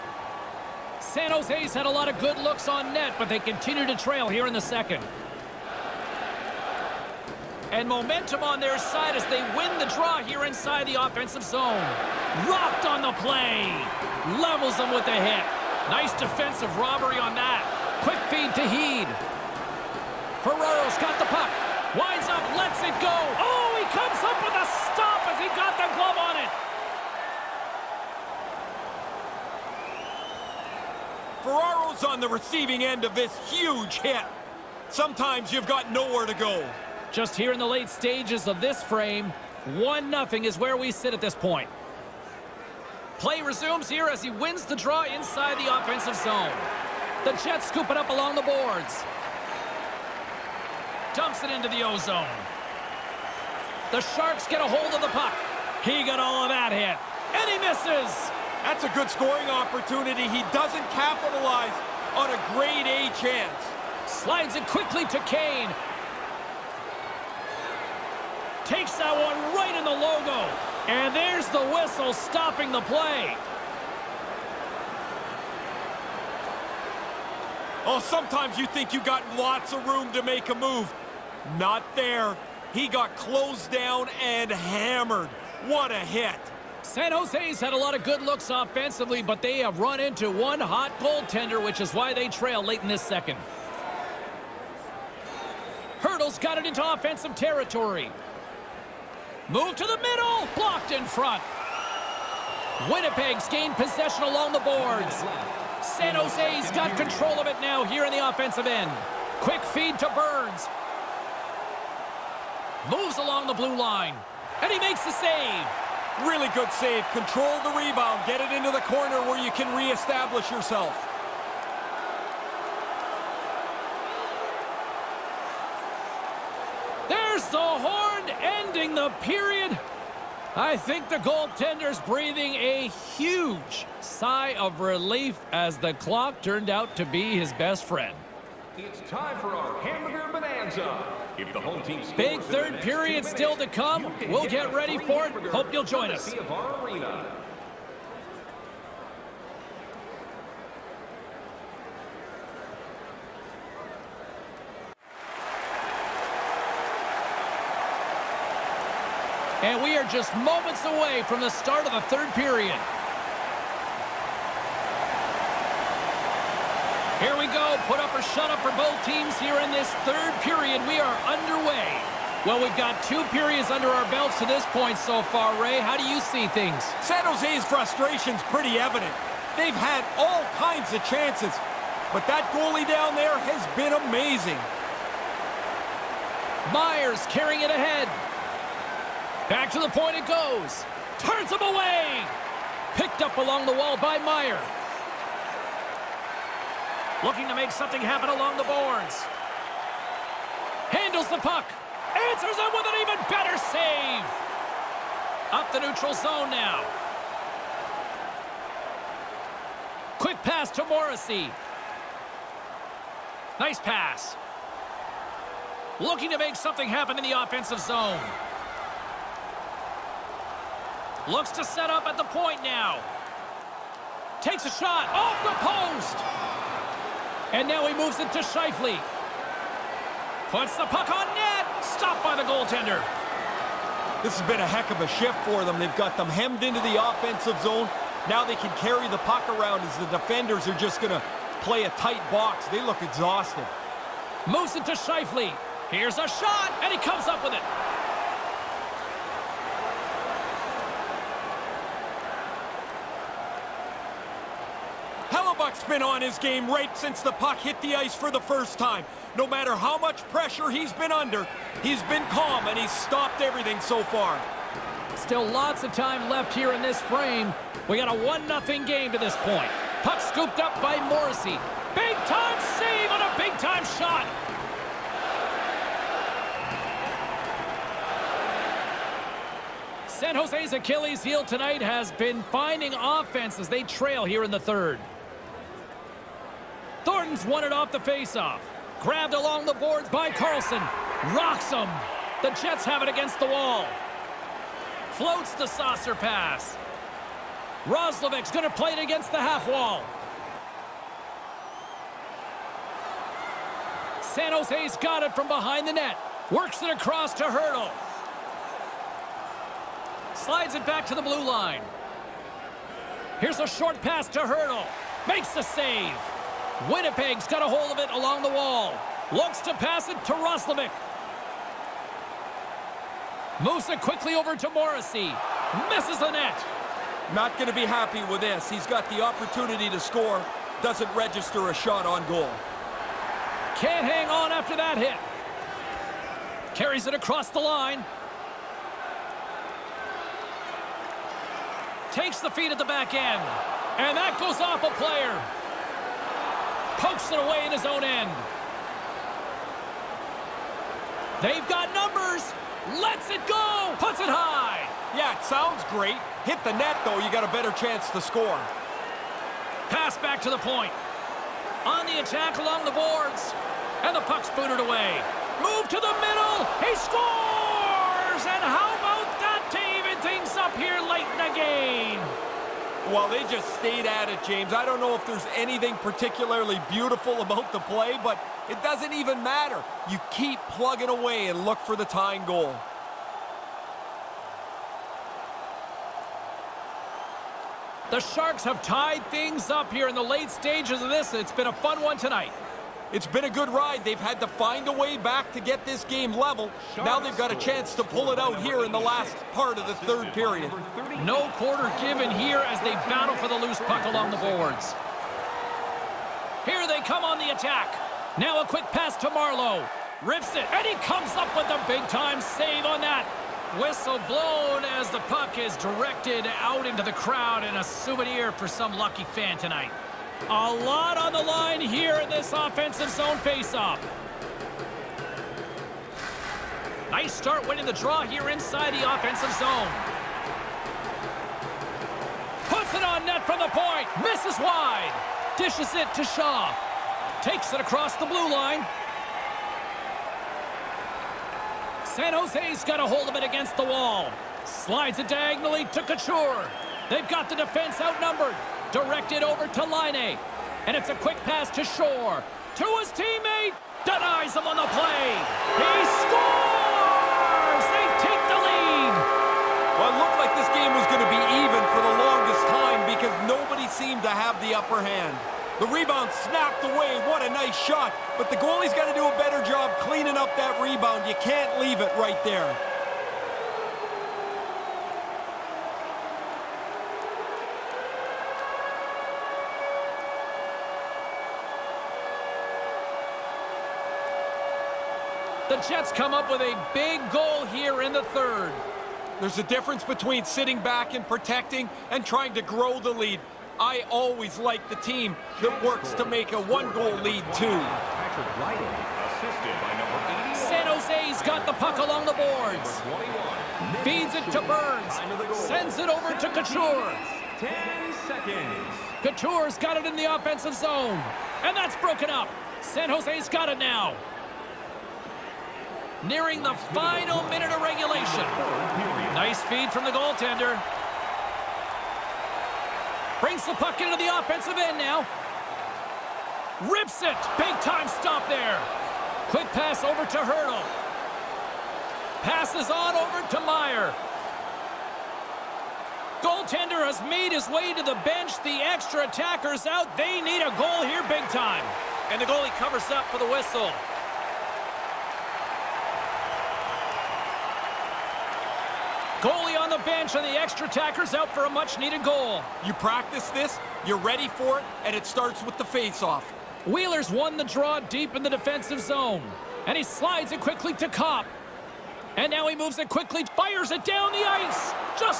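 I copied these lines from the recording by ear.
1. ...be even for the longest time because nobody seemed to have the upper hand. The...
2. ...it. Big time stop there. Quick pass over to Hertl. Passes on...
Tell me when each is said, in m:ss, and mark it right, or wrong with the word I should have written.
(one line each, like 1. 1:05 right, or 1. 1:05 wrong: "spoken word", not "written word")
1. 7:41 right
2. 8:47 right.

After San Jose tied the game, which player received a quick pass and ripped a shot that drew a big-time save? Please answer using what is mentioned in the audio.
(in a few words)
Marleau.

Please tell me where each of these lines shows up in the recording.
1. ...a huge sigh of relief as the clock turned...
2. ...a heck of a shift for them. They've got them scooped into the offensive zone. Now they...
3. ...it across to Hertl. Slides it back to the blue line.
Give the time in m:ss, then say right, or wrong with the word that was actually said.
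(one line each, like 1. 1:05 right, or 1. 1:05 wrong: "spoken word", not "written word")
1. 2:12 right
2. 3:54 wrong: "hemmed", not "scooped"
3. 5:06 right.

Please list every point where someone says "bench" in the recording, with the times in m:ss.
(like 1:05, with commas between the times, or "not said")
8:58, 9:10.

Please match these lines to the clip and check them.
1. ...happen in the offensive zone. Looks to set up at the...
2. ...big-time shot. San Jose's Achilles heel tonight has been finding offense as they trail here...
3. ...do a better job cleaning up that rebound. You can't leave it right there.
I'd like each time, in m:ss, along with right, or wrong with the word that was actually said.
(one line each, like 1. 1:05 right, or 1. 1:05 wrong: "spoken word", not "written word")
1. 3:36 right
2. 4:33 right
3. 7:49 right.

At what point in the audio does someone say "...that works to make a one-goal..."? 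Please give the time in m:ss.
8:15.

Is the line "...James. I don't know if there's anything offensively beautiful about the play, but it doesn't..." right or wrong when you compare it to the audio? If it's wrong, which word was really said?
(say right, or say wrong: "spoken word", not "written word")
wrong: "particularly", not "offensively".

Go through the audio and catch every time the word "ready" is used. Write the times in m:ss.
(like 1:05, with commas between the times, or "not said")
2:24, 9:14.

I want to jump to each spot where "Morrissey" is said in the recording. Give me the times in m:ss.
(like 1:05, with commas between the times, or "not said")
3:30, 4:31, 5:24.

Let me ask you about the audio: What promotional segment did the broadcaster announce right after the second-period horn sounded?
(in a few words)
hamburger bonanza.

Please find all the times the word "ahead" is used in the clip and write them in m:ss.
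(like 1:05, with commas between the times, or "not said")
3:07.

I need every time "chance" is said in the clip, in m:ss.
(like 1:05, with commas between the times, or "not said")
1:03, 3:01, 5:57, 6:37.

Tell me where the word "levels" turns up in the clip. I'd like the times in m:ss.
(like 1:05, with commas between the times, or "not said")
0:14, 6:36.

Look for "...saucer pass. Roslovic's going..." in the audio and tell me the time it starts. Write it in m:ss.
4:55.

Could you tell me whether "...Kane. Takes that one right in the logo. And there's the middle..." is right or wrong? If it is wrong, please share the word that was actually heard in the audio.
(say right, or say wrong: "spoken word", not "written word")
wrong: "whistle", not "middle".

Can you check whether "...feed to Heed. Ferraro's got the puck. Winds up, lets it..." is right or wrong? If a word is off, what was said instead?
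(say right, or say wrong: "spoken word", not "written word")
right.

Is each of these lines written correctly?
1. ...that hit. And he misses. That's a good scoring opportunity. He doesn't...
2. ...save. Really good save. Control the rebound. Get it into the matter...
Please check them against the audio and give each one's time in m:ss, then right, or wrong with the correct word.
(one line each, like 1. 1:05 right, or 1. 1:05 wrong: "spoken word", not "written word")
1. 0:56 right
2. 1:55 wrong: "corner", not "matter".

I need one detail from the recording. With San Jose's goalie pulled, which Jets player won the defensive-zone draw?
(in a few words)
Wheeler.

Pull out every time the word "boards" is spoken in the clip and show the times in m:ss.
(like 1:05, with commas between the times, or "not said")
0:48, 1:44, 3:18, 4:49, 6:02, 6:44, 8:22.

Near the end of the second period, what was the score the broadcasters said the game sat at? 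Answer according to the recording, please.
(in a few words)
1-0.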